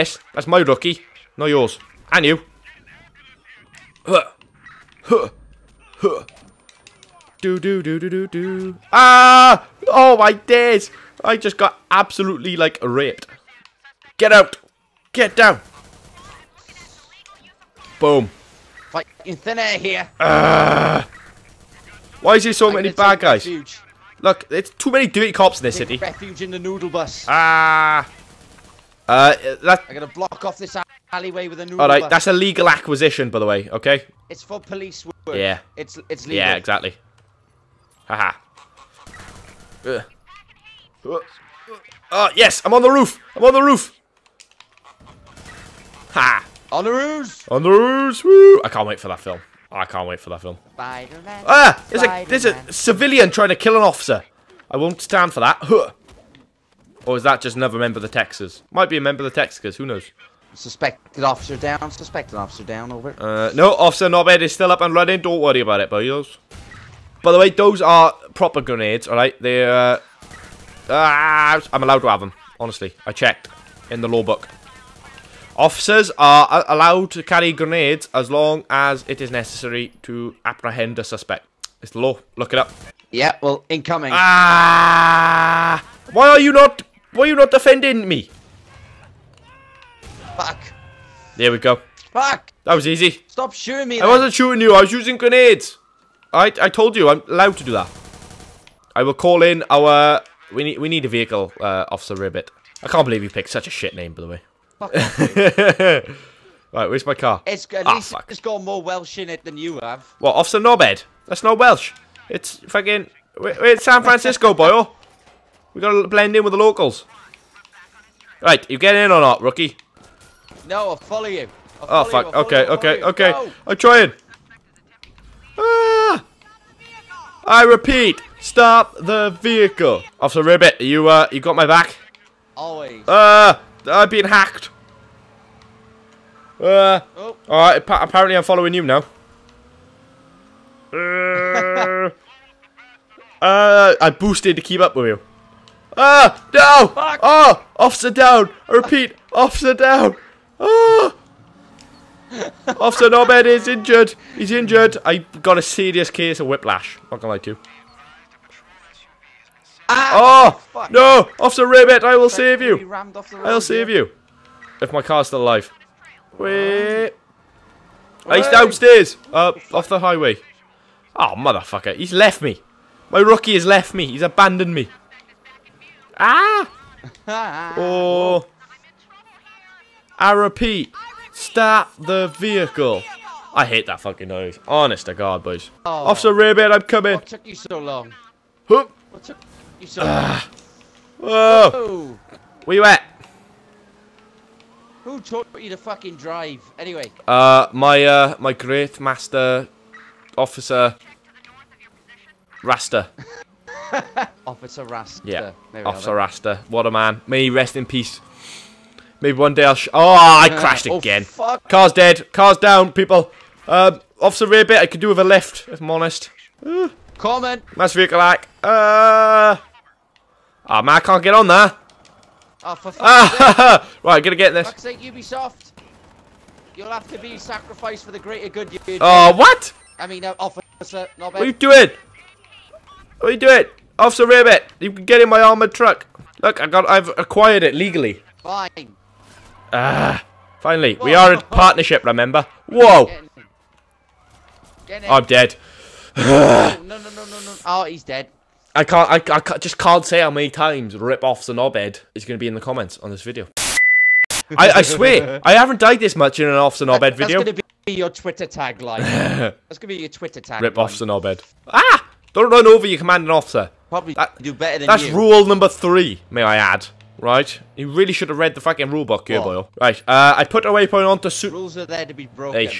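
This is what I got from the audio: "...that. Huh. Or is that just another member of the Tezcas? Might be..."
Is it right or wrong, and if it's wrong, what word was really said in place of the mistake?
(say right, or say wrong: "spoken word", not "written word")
right.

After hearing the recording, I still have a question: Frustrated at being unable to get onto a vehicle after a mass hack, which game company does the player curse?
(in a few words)
Ubisoft.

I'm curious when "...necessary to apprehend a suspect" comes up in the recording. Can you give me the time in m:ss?
1:19.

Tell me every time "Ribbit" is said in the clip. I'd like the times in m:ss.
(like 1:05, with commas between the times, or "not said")
1:42, 2:10.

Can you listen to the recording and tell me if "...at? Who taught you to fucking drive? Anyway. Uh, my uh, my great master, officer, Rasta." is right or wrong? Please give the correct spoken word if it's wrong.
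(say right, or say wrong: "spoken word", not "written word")
right.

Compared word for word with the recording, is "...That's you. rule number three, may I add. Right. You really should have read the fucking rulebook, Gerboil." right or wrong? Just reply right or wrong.
right.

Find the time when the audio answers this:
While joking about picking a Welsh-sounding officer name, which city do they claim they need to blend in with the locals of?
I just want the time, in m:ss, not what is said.
1:53.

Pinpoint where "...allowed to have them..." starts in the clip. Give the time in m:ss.
1:11.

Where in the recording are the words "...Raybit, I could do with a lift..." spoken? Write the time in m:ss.
3:34.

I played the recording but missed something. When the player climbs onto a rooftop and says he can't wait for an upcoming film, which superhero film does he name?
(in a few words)
Spider-Man.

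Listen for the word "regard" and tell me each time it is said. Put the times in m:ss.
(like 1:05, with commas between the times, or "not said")
not said.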